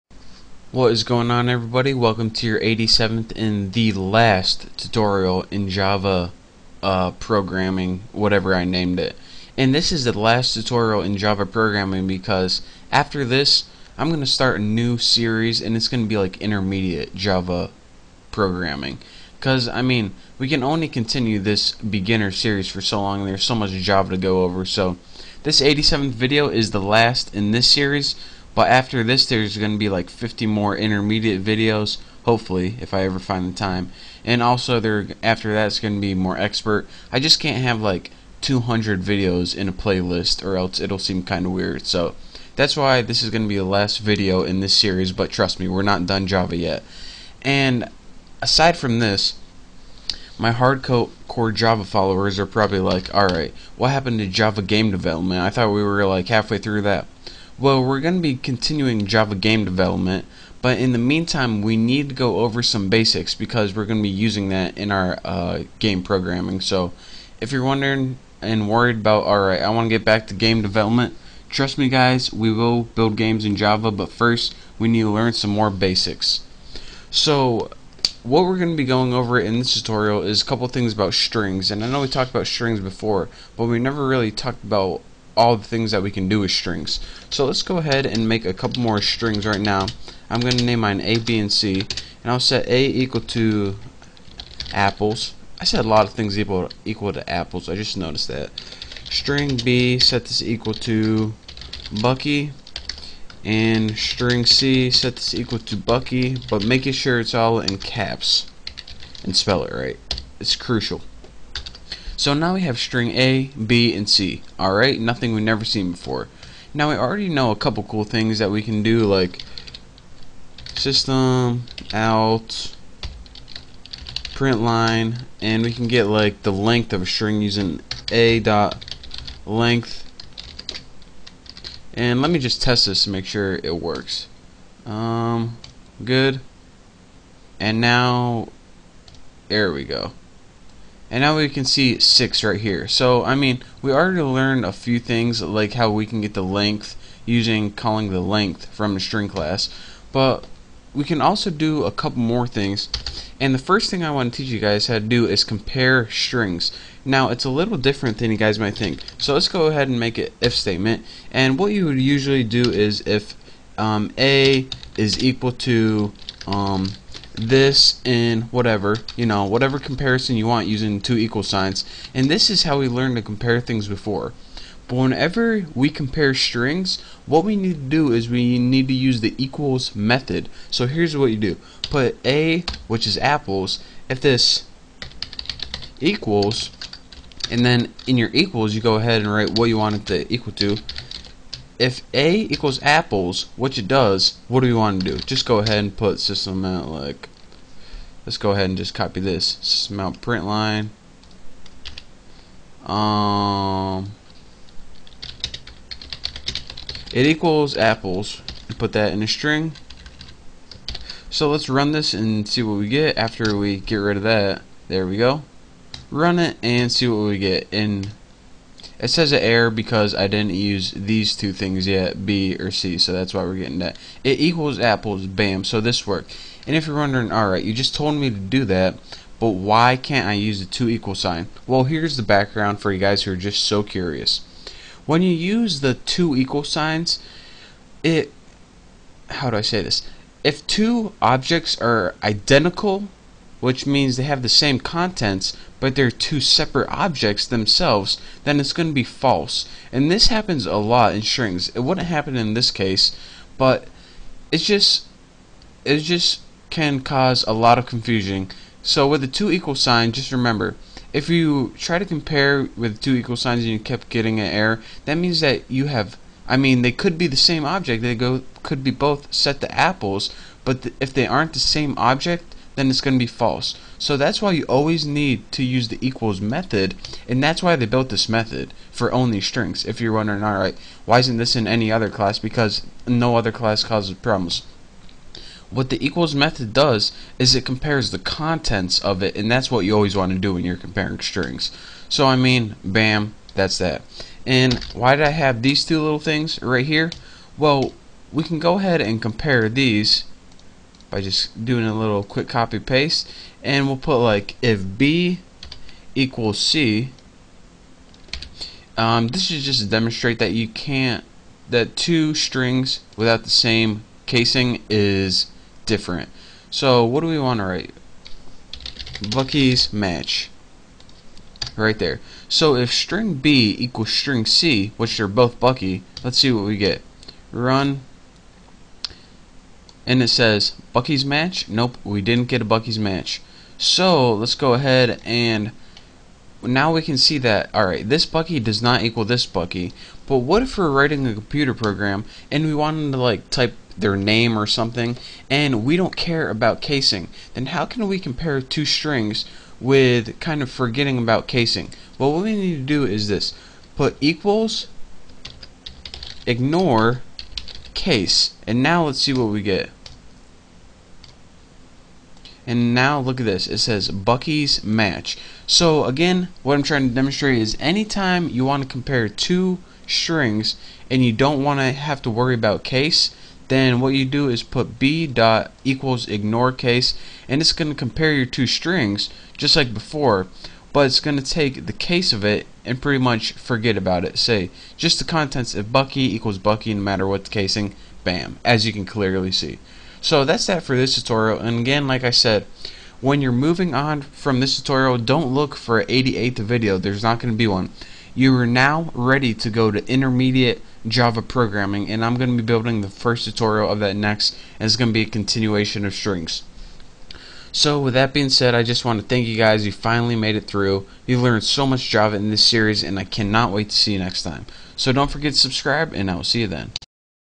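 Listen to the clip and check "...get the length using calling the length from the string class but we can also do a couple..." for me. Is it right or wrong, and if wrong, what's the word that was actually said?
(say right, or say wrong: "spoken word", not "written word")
right.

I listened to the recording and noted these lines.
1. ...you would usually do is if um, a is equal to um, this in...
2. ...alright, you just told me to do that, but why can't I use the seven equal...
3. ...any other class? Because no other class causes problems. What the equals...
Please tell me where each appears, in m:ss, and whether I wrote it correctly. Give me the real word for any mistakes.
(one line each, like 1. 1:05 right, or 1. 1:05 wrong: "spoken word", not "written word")
1. 2:41 right
2. 3:47 wrong: "two", not "seven"
3. 4:41 right.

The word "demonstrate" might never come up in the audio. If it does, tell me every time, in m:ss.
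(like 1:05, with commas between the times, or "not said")
5:09, 6:07.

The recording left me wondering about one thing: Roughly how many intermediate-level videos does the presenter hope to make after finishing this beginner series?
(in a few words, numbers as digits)
50.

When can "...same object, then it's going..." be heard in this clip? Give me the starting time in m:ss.
4:31.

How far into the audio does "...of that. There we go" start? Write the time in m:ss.
3:34.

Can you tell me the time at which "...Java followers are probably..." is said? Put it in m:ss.
0:51.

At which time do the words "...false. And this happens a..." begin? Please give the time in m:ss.
4:09.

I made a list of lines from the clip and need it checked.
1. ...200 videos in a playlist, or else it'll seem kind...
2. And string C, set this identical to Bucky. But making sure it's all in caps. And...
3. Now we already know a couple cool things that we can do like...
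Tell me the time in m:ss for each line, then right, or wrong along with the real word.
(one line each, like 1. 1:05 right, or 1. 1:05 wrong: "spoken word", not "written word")
1. 0:38 right
2. 1:43 wrong: "equal", not "identical"
3. 1:56 right.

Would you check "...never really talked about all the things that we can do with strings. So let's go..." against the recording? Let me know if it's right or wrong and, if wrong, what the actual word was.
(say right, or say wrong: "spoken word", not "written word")
right.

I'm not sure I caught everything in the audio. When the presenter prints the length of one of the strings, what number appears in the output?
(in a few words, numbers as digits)
6.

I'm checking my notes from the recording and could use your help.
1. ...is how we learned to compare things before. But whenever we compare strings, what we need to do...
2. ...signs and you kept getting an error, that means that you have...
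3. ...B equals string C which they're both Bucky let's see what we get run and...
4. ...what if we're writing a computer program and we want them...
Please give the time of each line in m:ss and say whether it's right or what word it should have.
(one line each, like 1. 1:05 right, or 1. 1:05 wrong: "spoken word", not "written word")
1. 2:52 right
2. 4:23 right
3. 5:23 right
4. 5:40 right.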